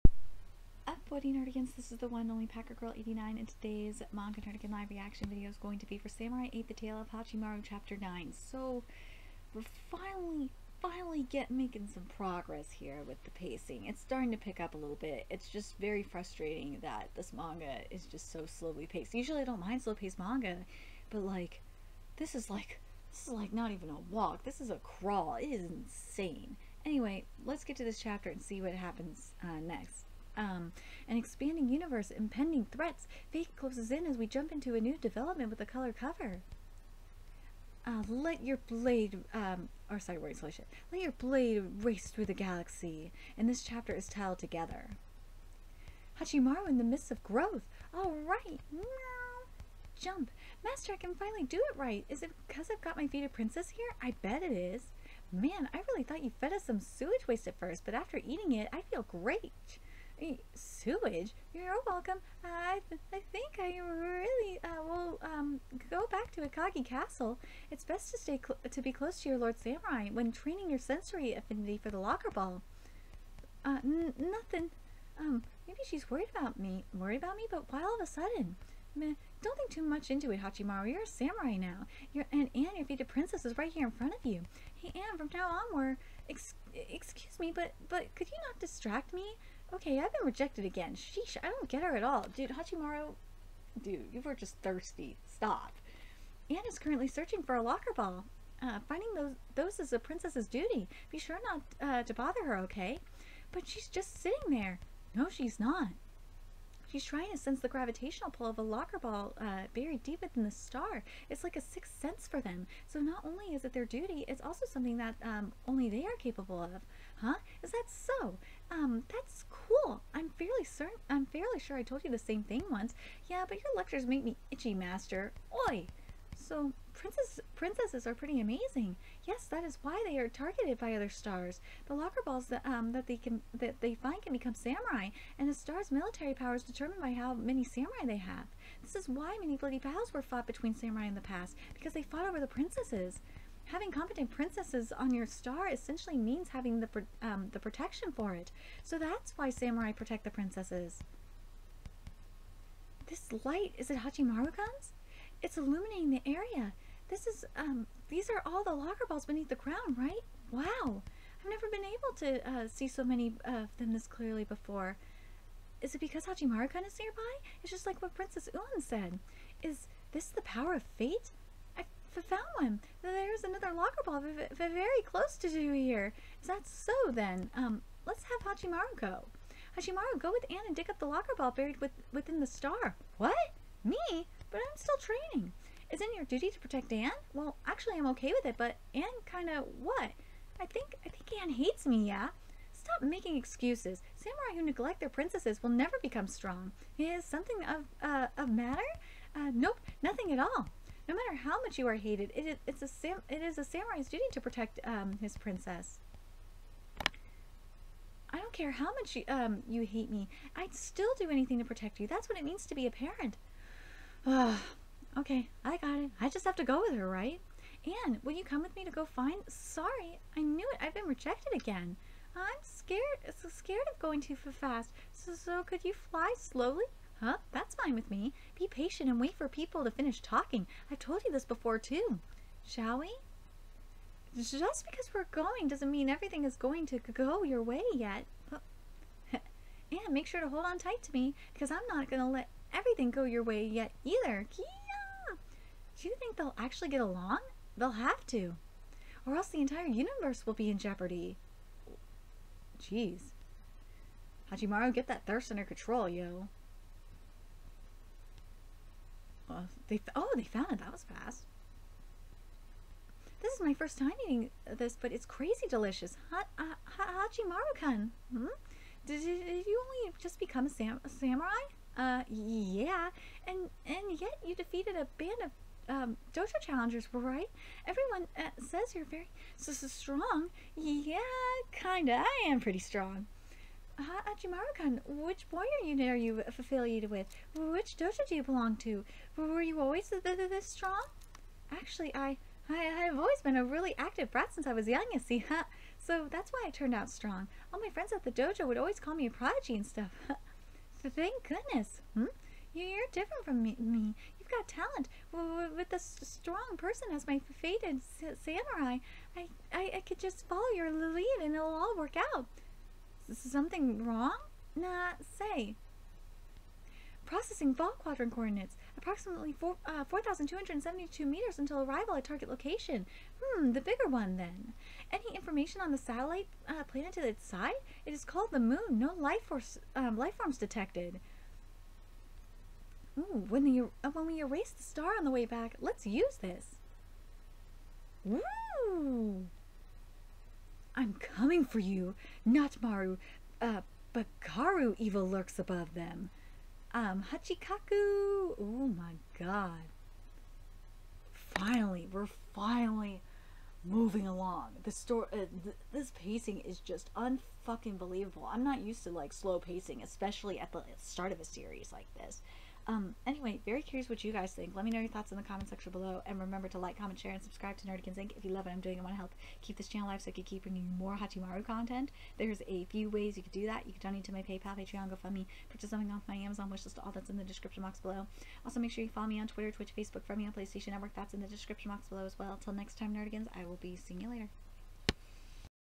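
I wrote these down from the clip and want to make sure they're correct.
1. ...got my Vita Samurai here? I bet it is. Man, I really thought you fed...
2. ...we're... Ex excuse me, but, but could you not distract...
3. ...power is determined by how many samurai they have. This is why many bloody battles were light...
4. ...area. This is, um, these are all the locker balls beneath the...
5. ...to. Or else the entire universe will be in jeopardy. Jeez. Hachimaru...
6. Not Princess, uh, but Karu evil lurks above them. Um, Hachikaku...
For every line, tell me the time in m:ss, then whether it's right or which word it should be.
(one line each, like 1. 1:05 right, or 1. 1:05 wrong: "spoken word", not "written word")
1. 0:52 wrong: "Princess", not "Samurai"
2. 1:25 right
3. 2:16 wrong: "fought", not "light"
4. 2:36 right
5. 4:08 right
6. 5:42 wrong: "Maru", not "Princess".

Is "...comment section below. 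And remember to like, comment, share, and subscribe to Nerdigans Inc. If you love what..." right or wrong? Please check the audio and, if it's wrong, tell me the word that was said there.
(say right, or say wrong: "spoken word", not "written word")
right.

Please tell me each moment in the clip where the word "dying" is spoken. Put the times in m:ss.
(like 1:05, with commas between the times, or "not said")
not said.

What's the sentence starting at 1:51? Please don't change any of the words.
It's like a sixth sense for them.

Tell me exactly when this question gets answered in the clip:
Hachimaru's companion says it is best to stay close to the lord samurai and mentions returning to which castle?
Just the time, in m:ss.
1:06.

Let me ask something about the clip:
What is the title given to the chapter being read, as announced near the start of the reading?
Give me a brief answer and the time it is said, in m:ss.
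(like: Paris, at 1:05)
Together, at 0:44.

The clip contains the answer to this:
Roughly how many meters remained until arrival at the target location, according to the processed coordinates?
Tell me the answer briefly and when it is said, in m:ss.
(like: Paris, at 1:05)
4,272 meters, at 5:20.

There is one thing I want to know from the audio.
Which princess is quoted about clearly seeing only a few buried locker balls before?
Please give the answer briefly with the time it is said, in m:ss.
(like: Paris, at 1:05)
Princess Ulan, at 2:48.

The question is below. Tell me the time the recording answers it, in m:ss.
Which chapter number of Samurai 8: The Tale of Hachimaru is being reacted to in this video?
0:07.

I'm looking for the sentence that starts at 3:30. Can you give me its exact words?
I'd still do anything to protect you.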